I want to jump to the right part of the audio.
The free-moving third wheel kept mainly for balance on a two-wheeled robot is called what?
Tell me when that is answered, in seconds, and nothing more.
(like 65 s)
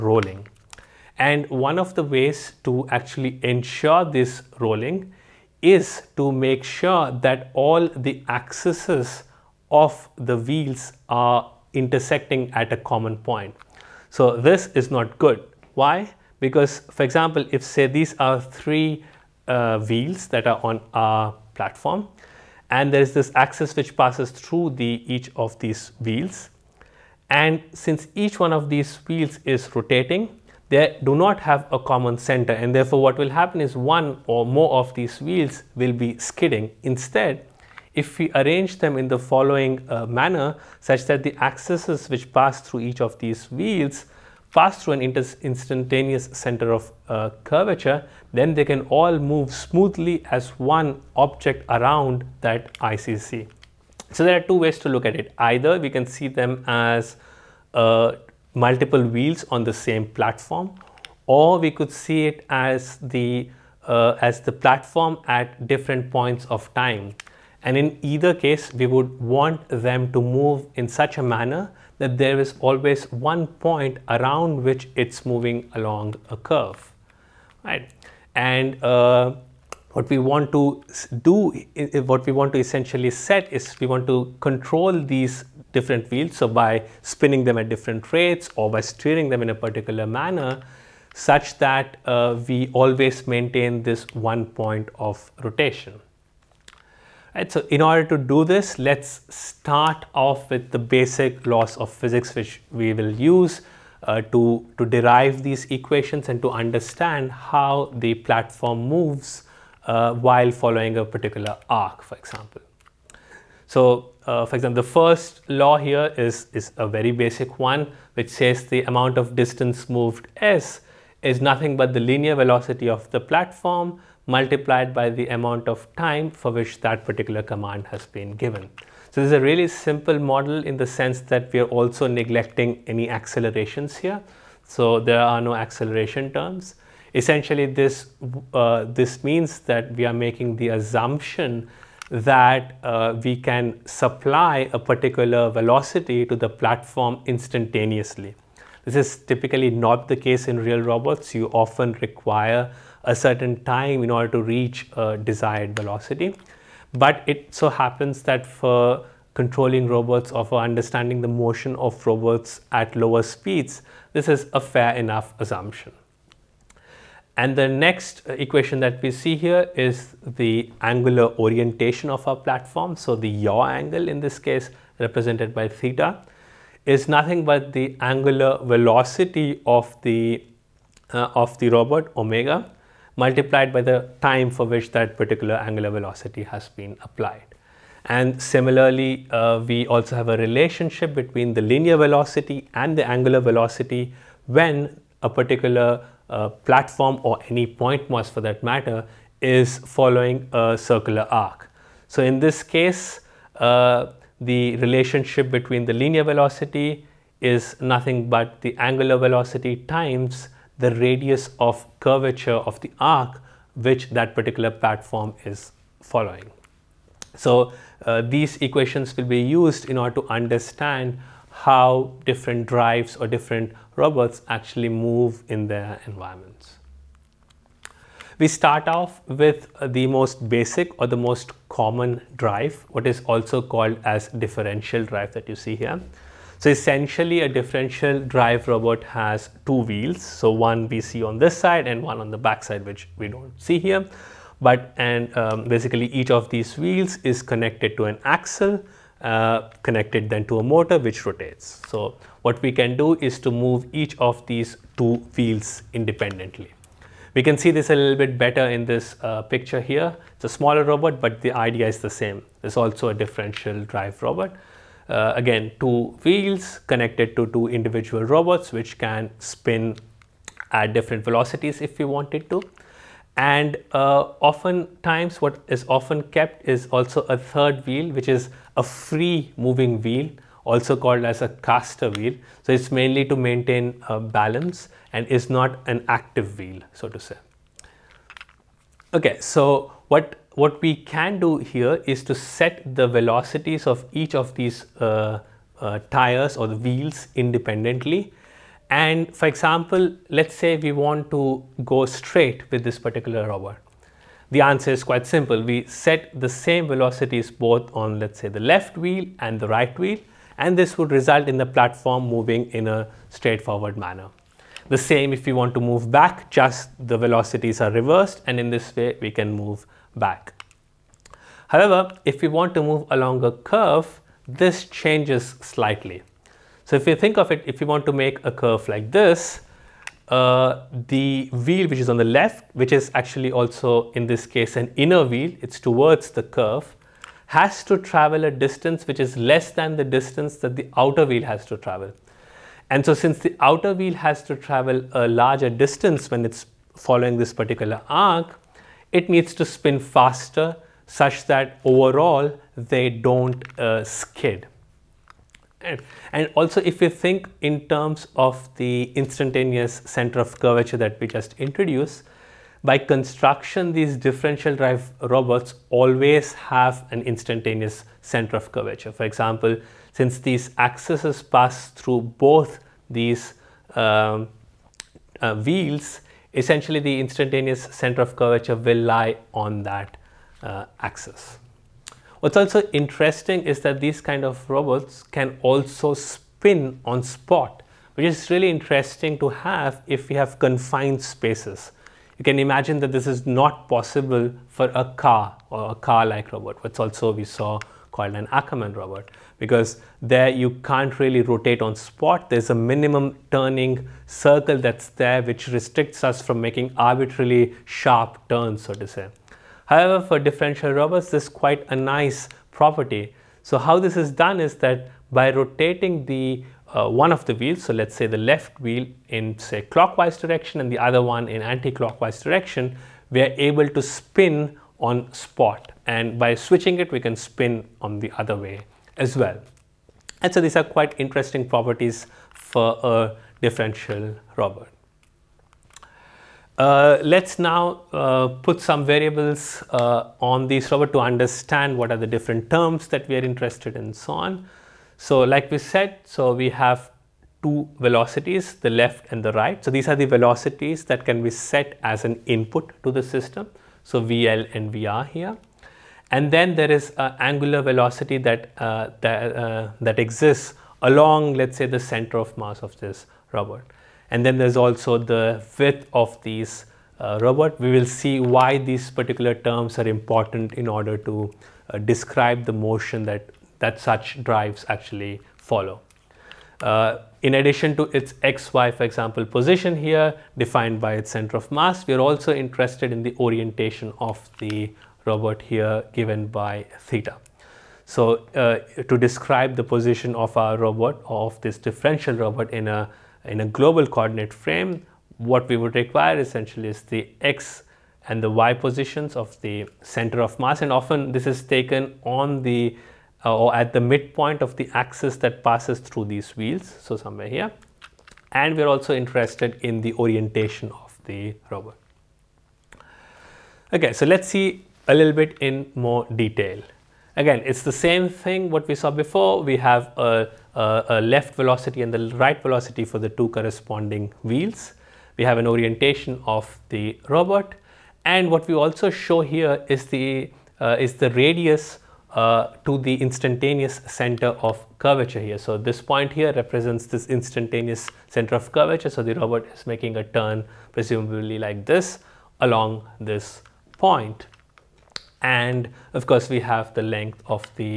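281 s.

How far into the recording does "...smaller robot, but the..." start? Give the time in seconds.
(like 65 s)
260 s.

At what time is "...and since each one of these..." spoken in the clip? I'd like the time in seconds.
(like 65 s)
27 s.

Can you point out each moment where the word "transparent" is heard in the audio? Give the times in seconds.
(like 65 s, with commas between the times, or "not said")
not said.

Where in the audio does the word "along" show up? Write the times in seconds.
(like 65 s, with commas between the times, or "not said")
75 s, 323 s, 461 s, 542 s.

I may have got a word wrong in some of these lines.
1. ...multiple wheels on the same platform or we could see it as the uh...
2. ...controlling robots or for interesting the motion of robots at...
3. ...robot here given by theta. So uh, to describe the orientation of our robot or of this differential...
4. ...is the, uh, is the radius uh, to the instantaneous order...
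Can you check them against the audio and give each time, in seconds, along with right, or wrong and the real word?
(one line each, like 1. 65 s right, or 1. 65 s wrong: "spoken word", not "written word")
1. 58 s right
2. 159 s wrong: "understanding", not "interesting"
3. 485 s wrong: "position", not "orientation"
4. 529 s wrong: "center", not "order".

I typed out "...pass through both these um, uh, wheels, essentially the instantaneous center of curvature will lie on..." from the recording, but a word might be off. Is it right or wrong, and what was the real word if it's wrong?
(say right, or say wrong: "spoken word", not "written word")
right.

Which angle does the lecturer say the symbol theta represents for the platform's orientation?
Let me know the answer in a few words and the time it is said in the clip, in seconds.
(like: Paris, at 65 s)
Yaw angle, at 173 s.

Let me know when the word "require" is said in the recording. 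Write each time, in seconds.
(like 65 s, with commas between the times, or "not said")
152 s, 495 s.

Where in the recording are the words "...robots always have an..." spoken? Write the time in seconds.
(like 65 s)
365 s.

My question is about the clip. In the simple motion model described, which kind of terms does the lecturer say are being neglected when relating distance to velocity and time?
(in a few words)
Acceleration terms.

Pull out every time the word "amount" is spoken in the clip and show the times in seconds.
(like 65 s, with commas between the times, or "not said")
118 s, 125 s.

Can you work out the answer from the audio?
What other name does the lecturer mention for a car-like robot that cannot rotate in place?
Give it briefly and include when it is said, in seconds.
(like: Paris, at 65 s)
Ackermann robot, at 398 s.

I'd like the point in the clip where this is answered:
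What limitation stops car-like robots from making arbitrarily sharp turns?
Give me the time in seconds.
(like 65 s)
402 s.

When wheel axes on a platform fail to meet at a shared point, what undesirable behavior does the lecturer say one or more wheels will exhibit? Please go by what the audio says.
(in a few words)
Skidding.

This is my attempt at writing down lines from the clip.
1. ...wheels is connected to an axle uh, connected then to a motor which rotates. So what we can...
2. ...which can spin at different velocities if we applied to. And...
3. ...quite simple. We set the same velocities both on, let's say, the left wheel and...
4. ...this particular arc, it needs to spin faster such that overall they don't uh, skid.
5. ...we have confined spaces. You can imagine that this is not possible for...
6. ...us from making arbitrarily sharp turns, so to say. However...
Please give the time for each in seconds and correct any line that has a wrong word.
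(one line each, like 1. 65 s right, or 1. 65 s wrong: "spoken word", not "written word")
1. 246 s right
2. 268 s wrong: "wanted", not "applied"
3. 305 s right
4. 347 s right
5. 390 s right
6. 406 s right.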